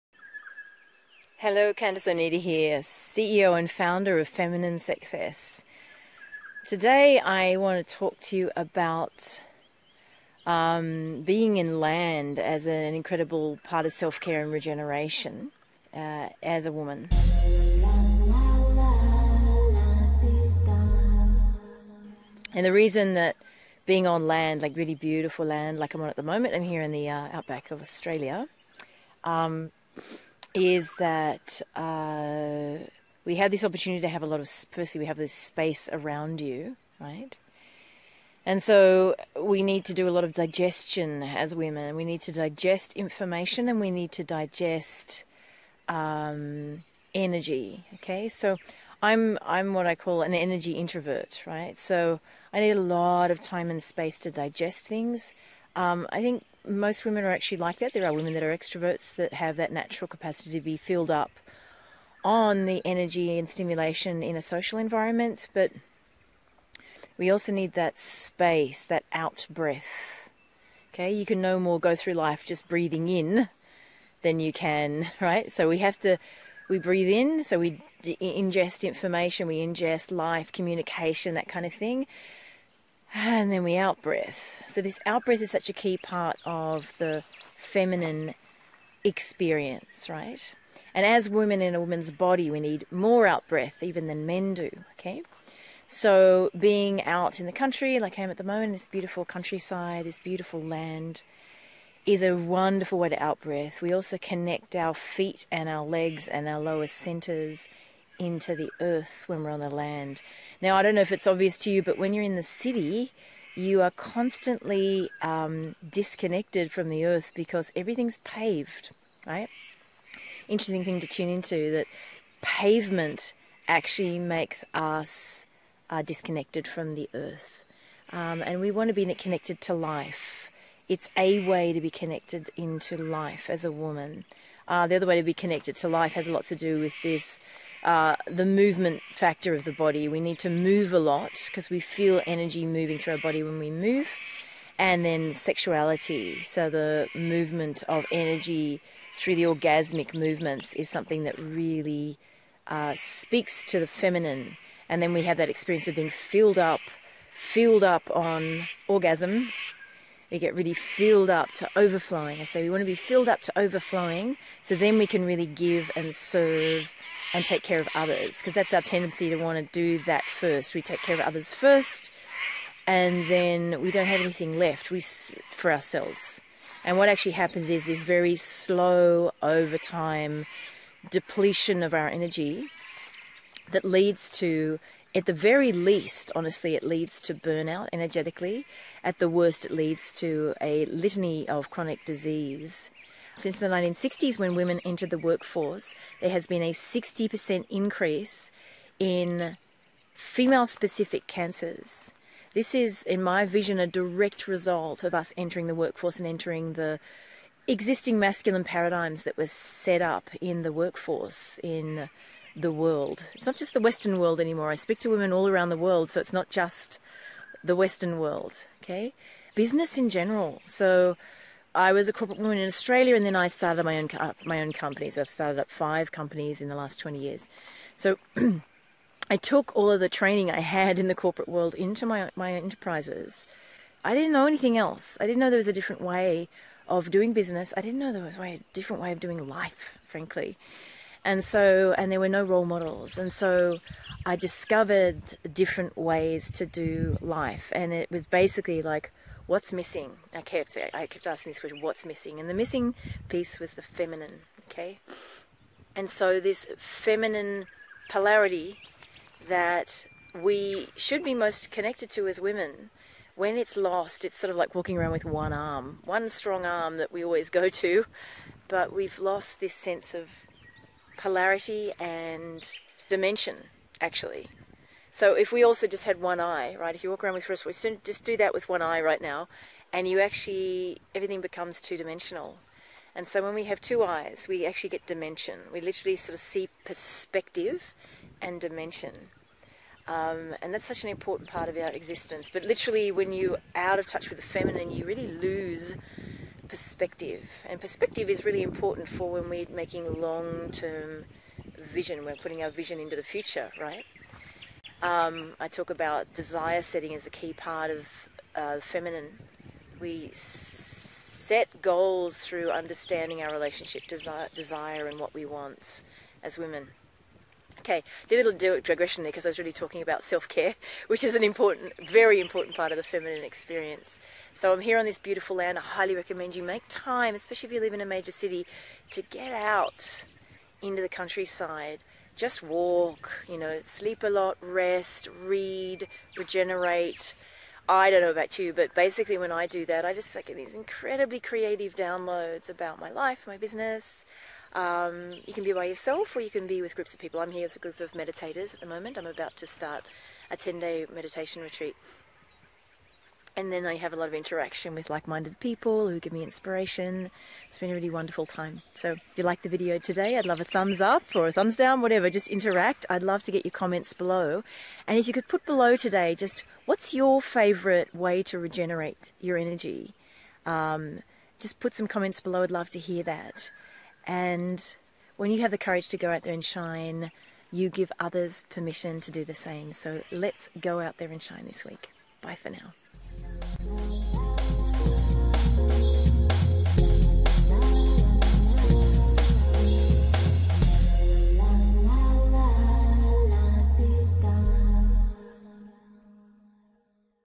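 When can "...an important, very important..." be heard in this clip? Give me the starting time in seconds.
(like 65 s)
321 s.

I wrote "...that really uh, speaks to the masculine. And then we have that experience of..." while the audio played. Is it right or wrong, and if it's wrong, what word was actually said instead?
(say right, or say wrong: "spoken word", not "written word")
wrong: "feminine", not "masculine".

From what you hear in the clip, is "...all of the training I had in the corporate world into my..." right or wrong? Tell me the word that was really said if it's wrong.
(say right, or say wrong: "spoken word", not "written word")
right.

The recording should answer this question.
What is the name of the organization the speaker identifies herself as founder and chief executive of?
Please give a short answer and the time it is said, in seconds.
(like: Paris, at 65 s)
Feminine Success, at 4 s.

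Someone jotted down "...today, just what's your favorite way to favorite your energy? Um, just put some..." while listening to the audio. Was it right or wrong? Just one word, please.
wrong.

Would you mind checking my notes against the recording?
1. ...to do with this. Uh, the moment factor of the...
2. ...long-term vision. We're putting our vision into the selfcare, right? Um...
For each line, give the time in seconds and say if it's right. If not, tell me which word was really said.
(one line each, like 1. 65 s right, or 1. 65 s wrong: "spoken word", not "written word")
1. 136 s wrong: "movement", not "moment"
2. 300 s wrong: "future", not "selfcare".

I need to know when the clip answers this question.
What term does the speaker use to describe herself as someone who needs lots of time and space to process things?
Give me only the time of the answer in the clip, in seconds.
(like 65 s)
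50 s.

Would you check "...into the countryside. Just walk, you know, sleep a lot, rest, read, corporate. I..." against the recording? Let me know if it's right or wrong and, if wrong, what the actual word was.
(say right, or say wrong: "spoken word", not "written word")
wrong: "regenerate", not "corporate".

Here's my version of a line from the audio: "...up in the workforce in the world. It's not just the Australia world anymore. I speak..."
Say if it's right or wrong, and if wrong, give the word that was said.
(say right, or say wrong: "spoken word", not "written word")
wrong: "Western", not "Australia".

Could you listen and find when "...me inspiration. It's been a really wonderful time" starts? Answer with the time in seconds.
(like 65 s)
356 s.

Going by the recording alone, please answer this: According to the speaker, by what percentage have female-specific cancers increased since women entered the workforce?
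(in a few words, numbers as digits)
60%.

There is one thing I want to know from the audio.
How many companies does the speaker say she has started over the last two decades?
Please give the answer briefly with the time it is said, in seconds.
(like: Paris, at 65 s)
5, at 225 s.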